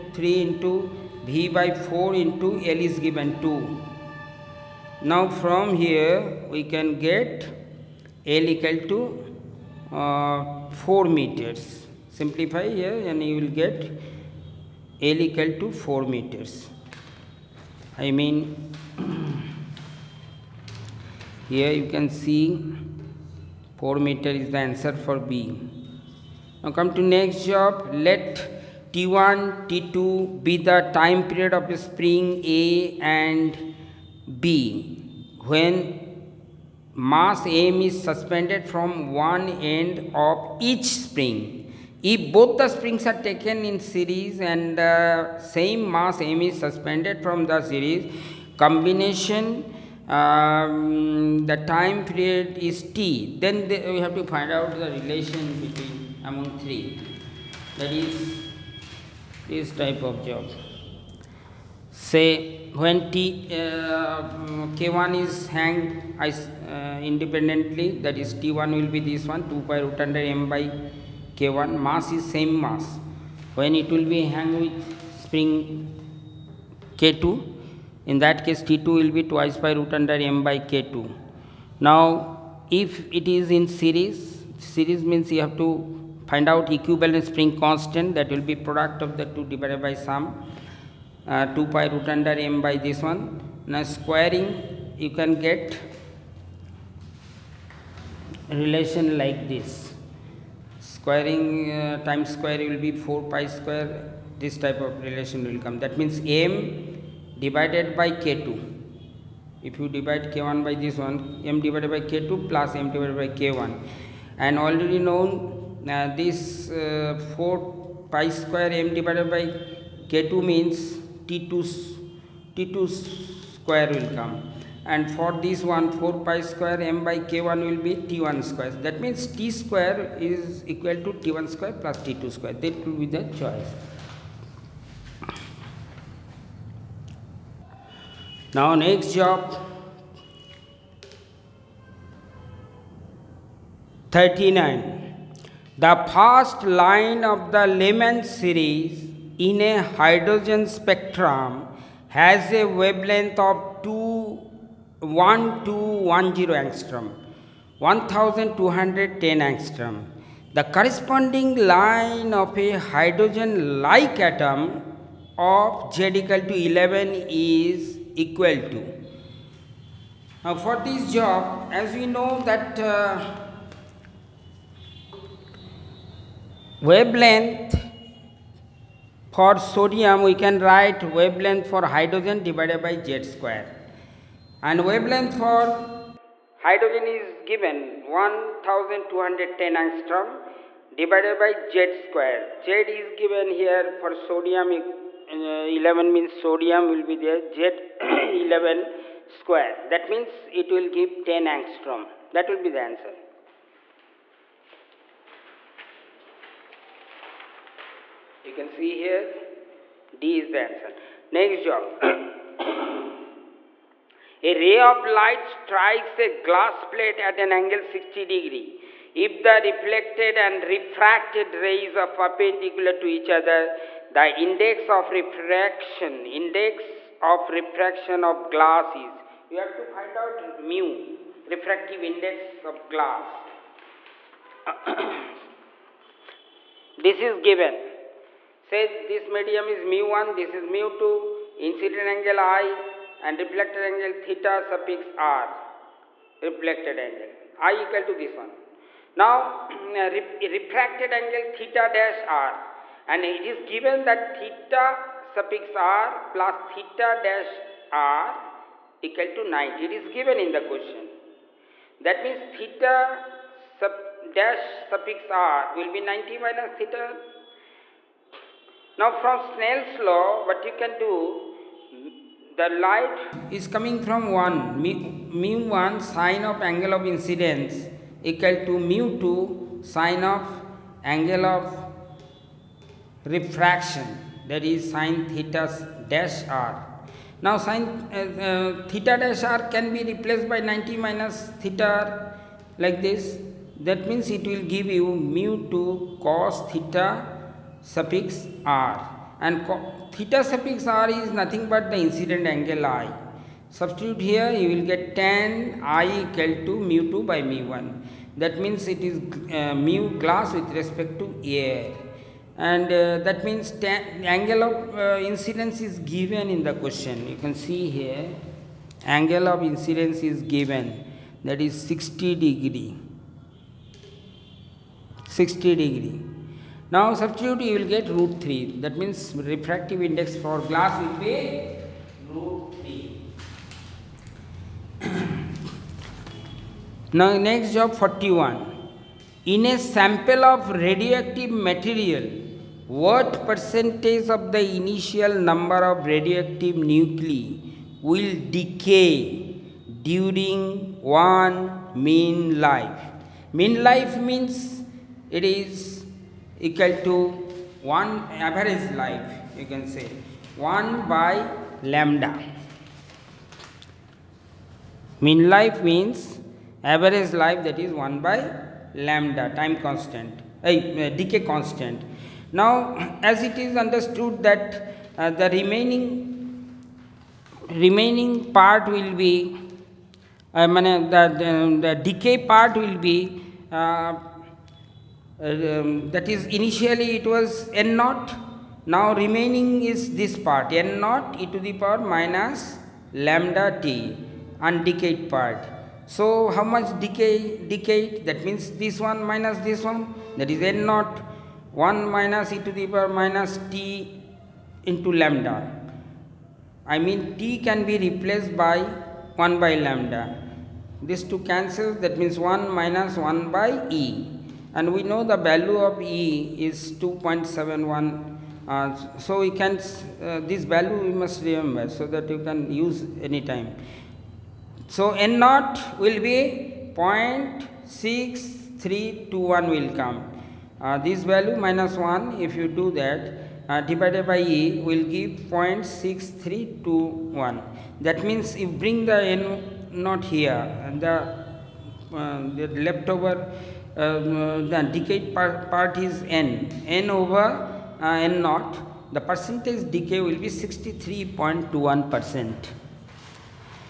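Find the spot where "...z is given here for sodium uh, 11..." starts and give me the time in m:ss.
3:12.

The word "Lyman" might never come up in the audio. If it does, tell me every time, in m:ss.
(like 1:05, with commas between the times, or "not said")
2:27.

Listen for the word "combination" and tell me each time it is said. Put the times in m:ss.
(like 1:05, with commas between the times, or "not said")
0:48.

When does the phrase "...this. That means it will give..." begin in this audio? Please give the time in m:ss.
4:53.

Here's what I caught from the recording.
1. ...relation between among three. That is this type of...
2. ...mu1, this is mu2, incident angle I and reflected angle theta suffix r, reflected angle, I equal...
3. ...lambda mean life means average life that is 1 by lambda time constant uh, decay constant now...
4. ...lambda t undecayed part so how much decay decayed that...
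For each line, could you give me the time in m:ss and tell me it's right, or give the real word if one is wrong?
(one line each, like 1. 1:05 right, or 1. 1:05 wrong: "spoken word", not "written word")
1. 0:54 right
2. 3:59 right
3. 6:01 right
4. 6:33 right.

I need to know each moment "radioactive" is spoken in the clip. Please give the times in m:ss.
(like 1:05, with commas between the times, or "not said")
5:40, 5:46.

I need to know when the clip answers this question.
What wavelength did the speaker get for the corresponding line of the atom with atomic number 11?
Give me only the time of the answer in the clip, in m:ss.
3:21.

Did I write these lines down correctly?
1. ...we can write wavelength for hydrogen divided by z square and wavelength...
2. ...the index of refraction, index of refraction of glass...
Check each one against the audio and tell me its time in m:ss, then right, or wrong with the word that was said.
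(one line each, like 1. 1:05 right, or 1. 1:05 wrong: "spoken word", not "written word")
1. 3:00 right
2. 3:44 right.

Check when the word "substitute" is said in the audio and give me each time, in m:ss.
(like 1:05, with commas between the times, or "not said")
5:03, 5:27.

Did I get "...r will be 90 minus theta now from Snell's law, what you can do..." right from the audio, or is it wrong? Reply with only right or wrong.
right.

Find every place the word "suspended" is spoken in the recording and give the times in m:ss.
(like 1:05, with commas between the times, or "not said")
0:38, 0:46.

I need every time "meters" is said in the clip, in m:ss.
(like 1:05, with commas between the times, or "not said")
0:11, 0:16, 0:24.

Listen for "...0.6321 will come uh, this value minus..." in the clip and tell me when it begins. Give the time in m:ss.
7:06.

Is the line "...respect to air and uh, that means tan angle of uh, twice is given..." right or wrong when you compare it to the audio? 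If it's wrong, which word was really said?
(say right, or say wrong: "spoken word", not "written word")
wrong: "incidence", not "twice".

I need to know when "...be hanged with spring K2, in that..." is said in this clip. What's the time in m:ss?
1:14.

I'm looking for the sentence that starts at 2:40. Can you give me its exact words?
The corresponding line of a hydrogen-like atom of Z equal to 11 is equal to.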